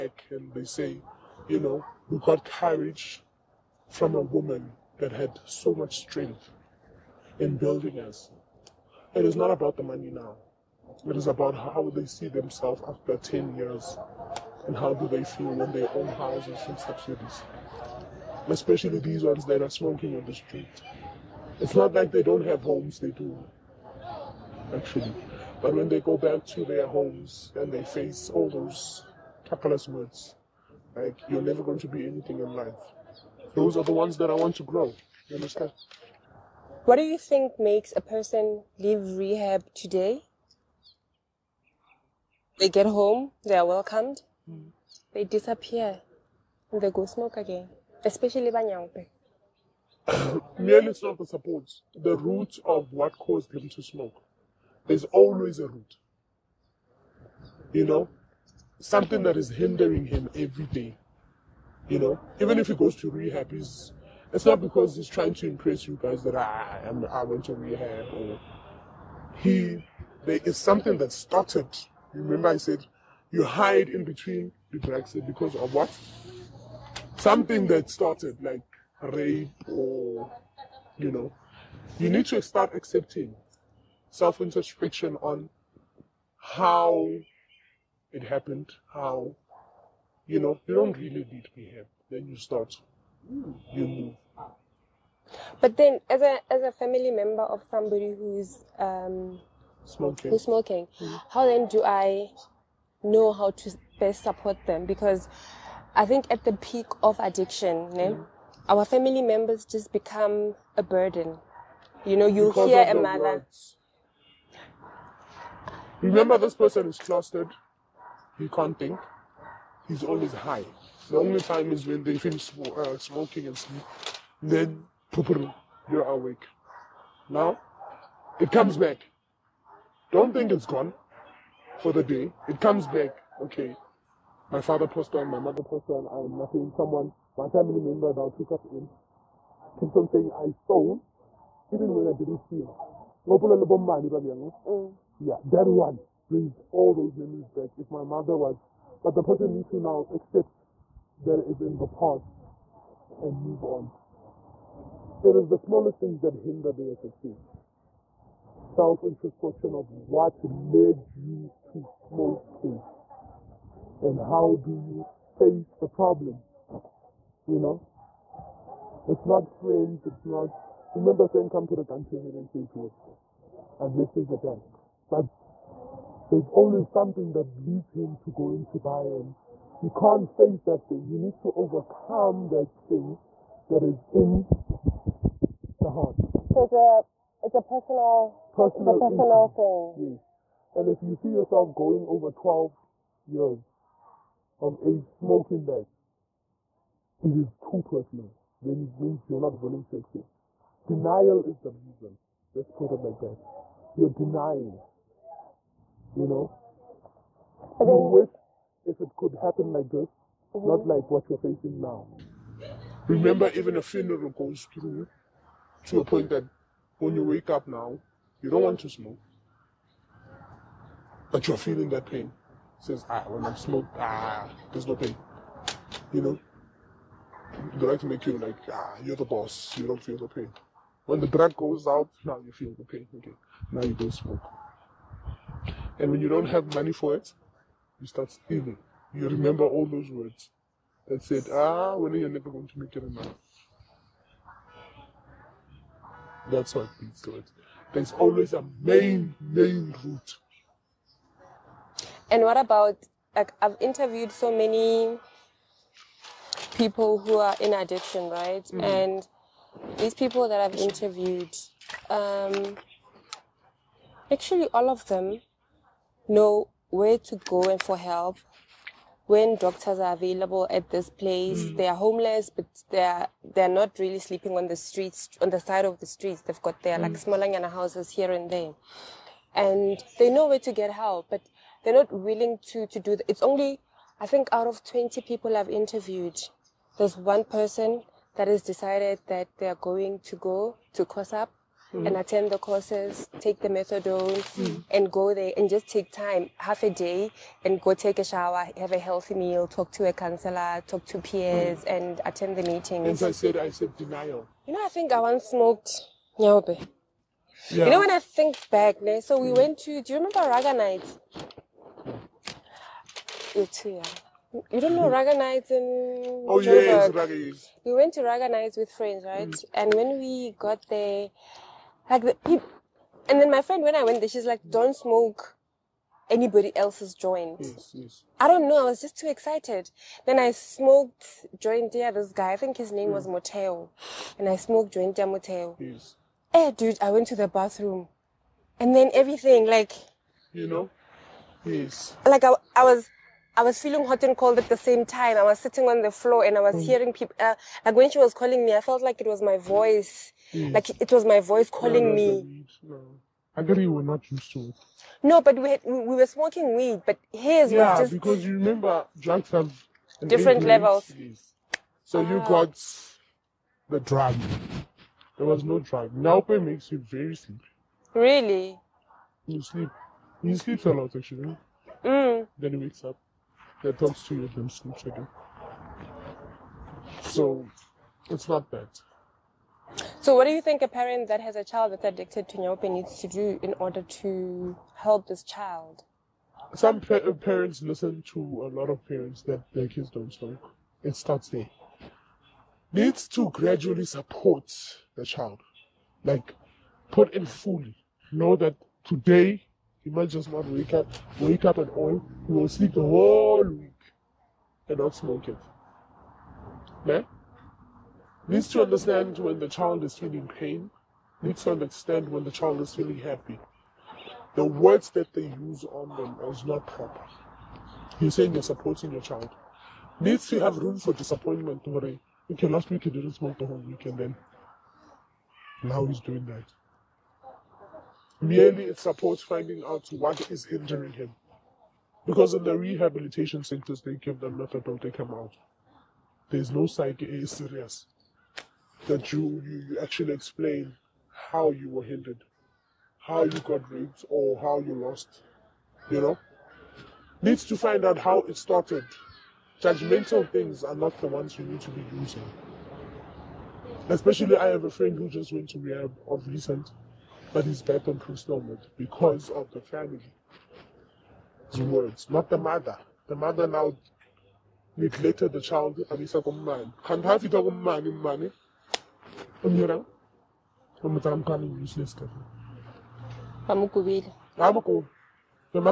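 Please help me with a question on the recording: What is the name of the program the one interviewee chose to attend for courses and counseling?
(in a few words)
COSUP.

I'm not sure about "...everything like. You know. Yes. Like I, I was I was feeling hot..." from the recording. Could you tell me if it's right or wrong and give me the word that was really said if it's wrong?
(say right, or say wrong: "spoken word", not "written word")
right.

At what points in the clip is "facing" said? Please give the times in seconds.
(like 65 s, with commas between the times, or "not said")
211 s.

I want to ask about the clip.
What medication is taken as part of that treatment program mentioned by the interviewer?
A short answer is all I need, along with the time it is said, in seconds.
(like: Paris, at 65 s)
Methadone, at 293 s.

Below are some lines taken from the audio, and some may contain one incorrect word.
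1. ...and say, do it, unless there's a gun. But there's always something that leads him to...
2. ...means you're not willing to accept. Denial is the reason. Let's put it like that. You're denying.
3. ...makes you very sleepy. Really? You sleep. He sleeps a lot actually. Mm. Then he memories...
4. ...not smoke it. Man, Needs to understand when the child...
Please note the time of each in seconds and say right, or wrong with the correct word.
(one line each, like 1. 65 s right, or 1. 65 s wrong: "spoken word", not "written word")
1. 172 s right
2. 198 s right
3. 366 s wrong: "wakes", not "memories"
4. 404 s right.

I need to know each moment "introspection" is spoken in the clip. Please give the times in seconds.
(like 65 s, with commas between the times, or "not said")
84 s, 159 s.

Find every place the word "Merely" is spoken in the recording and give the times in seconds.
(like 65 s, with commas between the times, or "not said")
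50 s, 428 s.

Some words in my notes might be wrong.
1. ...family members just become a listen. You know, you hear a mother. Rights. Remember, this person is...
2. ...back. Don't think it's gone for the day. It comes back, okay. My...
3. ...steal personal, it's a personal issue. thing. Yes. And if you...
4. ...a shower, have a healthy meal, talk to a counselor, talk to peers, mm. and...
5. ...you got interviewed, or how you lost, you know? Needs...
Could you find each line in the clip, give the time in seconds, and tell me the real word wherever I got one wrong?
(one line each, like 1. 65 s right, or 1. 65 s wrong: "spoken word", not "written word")
1. 108 s wrong: "burden", not "listen"
2. 128 s right
3. 187 s wrong: "personal", not "steal"
4. 298 s right
5. 443 s wrong: "raped", not "interviewed".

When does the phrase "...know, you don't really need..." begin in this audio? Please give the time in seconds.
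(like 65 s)
90 s.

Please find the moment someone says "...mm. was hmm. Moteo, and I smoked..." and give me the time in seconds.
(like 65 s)
333 s.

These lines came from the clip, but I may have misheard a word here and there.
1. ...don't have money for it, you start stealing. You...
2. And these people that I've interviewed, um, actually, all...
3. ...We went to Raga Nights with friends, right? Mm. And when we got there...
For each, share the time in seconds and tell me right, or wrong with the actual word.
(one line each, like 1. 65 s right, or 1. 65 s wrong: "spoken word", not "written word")
1. 236 s right
2. 258 s right
3. 317 s right.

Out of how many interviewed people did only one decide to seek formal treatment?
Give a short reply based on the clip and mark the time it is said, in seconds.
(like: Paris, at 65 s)
20, at 284 s.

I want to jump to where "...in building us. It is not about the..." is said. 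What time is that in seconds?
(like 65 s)
7 s.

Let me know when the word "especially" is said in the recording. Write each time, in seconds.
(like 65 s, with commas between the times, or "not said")
18 s, 48 s, 454 s.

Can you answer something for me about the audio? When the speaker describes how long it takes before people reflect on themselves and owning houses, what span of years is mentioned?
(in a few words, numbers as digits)
10 years.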